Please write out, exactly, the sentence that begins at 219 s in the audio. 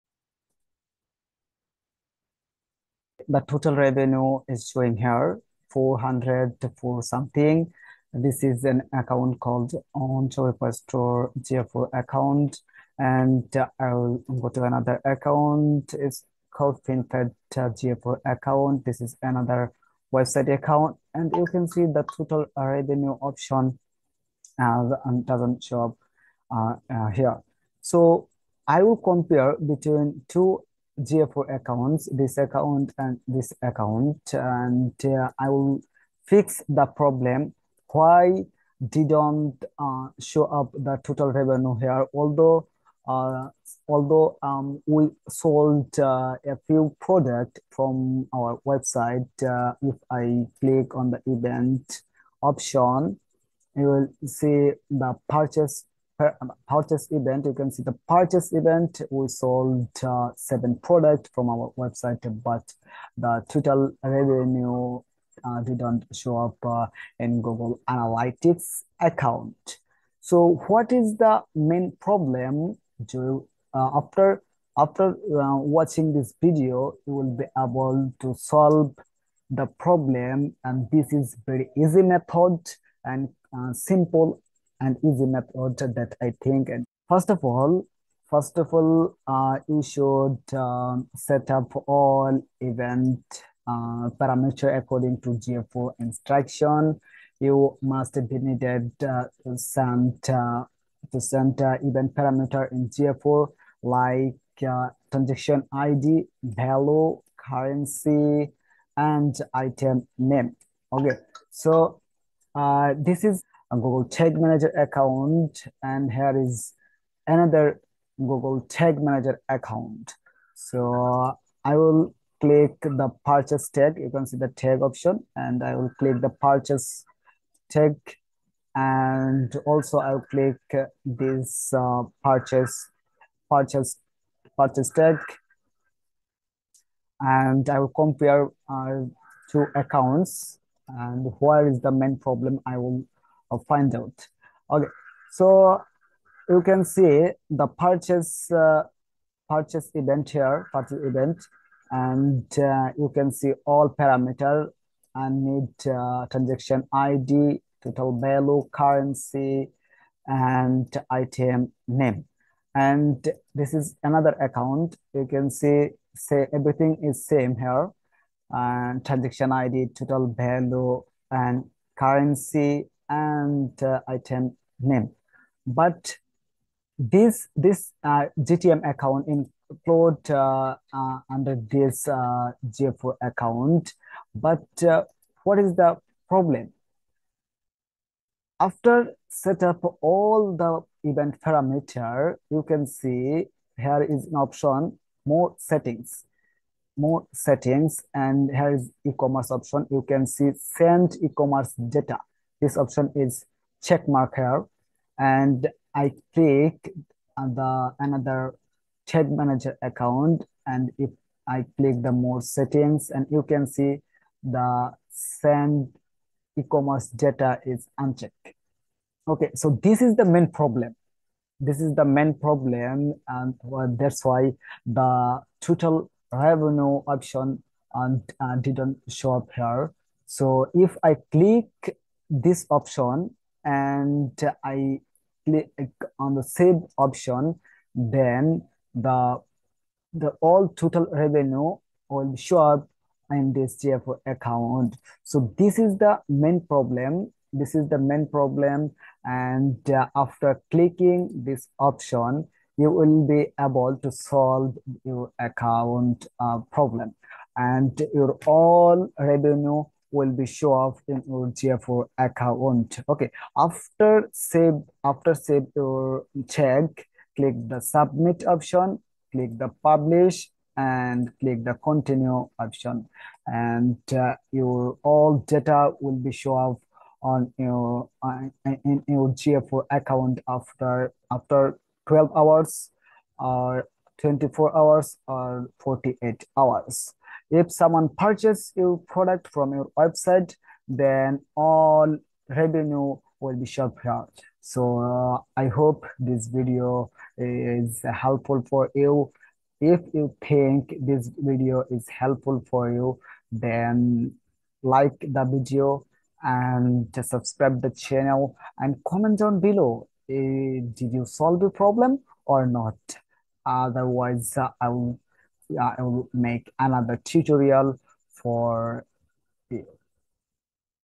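Okay, so this is the main problem.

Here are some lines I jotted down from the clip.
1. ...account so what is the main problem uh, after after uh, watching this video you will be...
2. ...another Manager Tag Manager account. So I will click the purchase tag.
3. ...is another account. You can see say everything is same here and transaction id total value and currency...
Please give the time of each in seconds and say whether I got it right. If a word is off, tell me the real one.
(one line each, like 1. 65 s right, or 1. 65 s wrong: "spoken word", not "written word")
1. 68 s right
2. 117 s wrong: "Google", not "Manager"
3. 163 s right.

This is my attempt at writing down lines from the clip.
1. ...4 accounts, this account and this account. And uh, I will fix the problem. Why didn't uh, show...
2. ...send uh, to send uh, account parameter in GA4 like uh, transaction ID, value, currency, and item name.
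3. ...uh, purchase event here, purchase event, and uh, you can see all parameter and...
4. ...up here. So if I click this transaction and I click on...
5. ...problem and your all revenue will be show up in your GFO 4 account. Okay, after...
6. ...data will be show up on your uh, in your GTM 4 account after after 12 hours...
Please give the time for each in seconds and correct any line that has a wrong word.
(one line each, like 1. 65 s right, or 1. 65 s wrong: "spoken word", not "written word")
1. 31 s right
2. 99 s wrong: "event", not "account"
3. 148 s right
4. 229 s wrong: "option", not "transaction"
5. 256 s right
6. 275 s wrong: "GFO", not "GTM".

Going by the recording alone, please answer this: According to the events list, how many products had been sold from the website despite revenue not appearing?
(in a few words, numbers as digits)
7.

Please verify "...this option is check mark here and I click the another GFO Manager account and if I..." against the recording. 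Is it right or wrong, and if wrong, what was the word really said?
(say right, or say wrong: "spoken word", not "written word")
wrong: "Tag", not "GFO".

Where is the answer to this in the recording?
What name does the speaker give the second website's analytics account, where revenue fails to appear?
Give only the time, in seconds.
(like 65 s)
16 s.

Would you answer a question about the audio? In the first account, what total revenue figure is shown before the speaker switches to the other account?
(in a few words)
400.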